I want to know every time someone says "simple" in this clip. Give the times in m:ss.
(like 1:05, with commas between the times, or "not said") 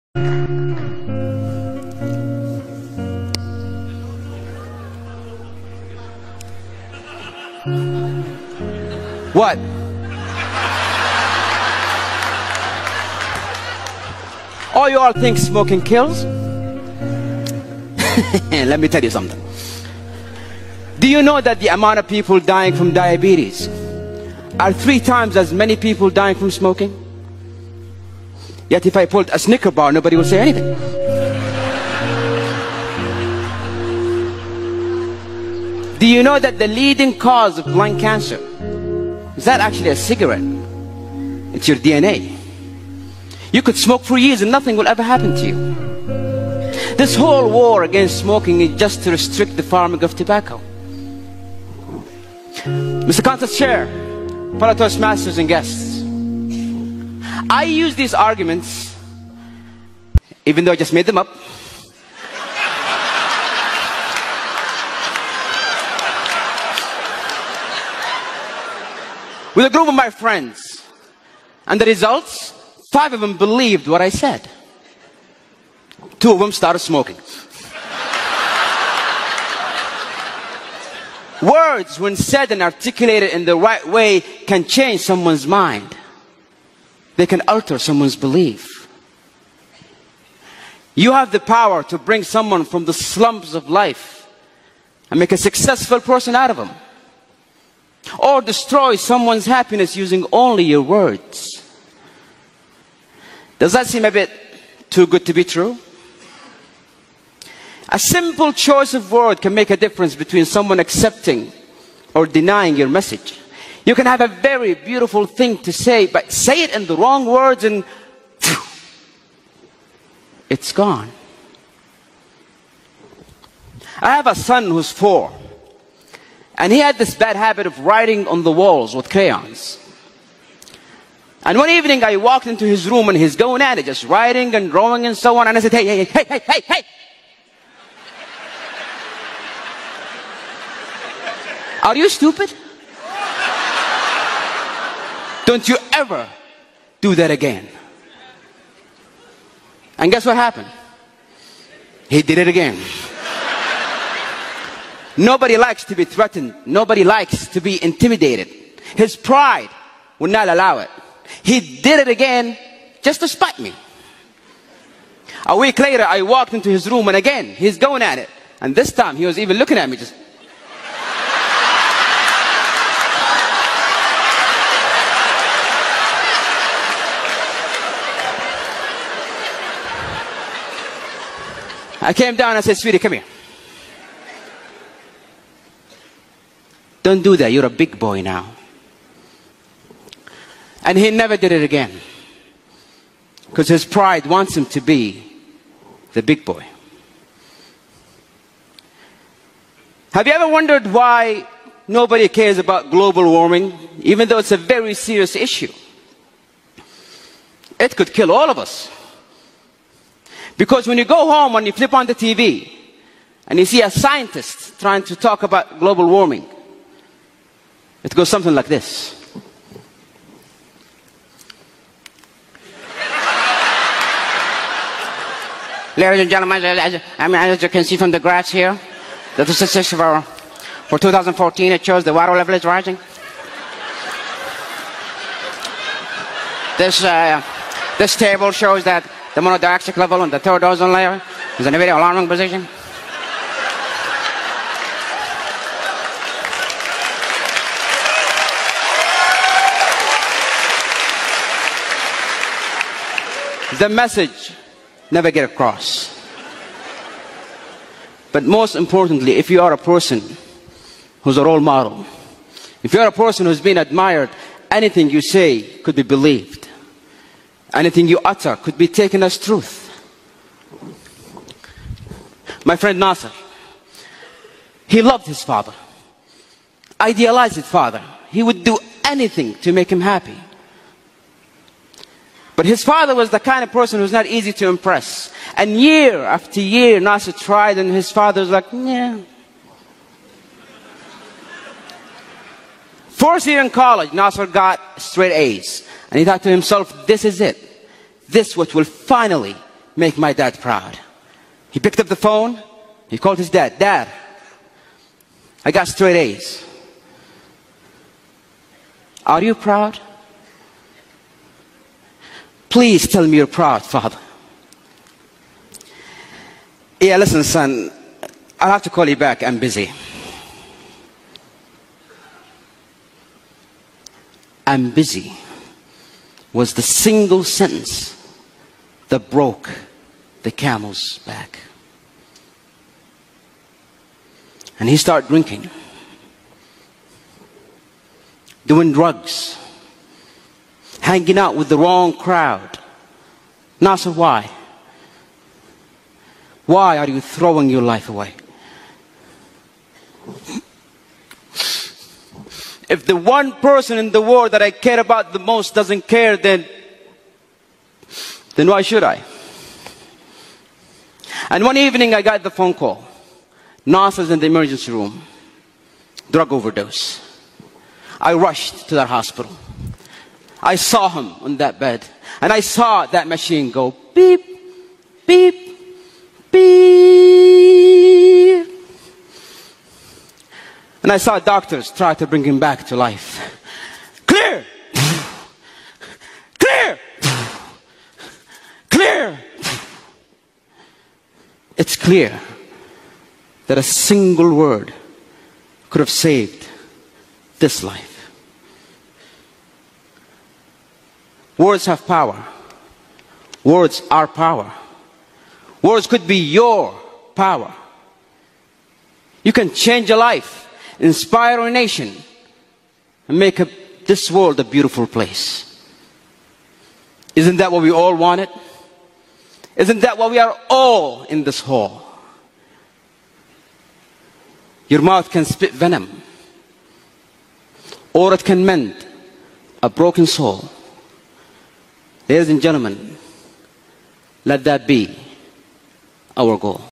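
1:47.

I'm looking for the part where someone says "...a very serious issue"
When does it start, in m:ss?
3:24.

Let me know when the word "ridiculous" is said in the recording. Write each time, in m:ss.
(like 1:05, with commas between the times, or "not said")
not said.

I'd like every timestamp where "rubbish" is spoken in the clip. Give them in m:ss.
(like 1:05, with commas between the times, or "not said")
not said.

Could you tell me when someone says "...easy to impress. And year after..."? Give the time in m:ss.
4:44.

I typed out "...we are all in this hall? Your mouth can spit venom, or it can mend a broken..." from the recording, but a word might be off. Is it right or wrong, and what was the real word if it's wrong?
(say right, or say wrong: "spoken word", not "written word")
right.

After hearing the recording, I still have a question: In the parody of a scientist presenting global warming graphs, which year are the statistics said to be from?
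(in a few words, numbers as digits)
2014.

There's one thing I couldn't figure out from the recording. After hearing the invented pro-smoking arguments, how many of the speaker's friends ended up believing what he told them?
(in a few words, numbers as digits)
5.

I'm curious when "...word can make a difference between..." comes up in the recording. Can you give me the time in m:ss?
1:49.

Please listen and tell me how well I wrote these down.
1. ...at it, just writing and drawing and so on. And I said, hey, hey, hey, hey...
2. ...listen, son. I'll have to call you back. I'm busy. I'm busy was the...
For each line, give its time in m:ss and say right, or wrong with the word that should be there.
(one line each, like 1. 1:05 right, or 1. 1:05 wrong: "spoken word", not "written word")
1. 2:13 right
2. 5:17 right.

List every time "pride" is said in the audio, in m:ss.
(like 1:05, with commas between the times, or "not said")
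2:39, 3:13.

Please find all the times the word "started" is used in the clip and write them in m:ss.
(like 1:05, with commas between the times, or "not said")
1:16, 5:34.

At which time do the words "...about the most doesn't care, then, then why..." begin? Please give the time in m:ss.
5:54.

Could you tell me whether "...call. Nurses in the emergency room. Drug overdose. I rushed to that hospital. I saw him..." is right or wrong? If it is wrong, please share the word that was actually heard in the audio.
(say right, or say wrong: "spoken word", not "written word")
right.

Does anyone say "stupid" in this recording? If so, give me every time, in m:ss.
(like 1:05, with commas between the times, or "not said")
2:22.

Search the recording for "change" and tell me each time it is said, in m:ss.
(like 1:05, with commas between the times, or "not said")
1:24, 6:49.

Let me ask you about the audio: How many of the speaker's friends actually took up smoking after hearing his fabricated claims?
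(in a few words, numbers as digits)
2.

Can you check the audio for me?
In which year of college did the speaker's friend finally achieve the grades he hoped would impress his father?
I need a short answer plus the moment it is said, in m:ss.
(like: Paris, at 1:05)
Fourth year, at 4:53.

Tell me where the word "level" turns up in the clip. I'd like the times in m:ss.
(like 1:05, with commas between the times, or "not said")
3:52, 3:59.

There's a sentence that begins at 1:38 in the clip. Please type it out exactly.
Or destroy someone's happiness using only your words.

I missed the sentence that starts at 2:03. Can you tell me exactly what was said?
I have a son who's four, and he had this bad habit of writing on the walls with crayons.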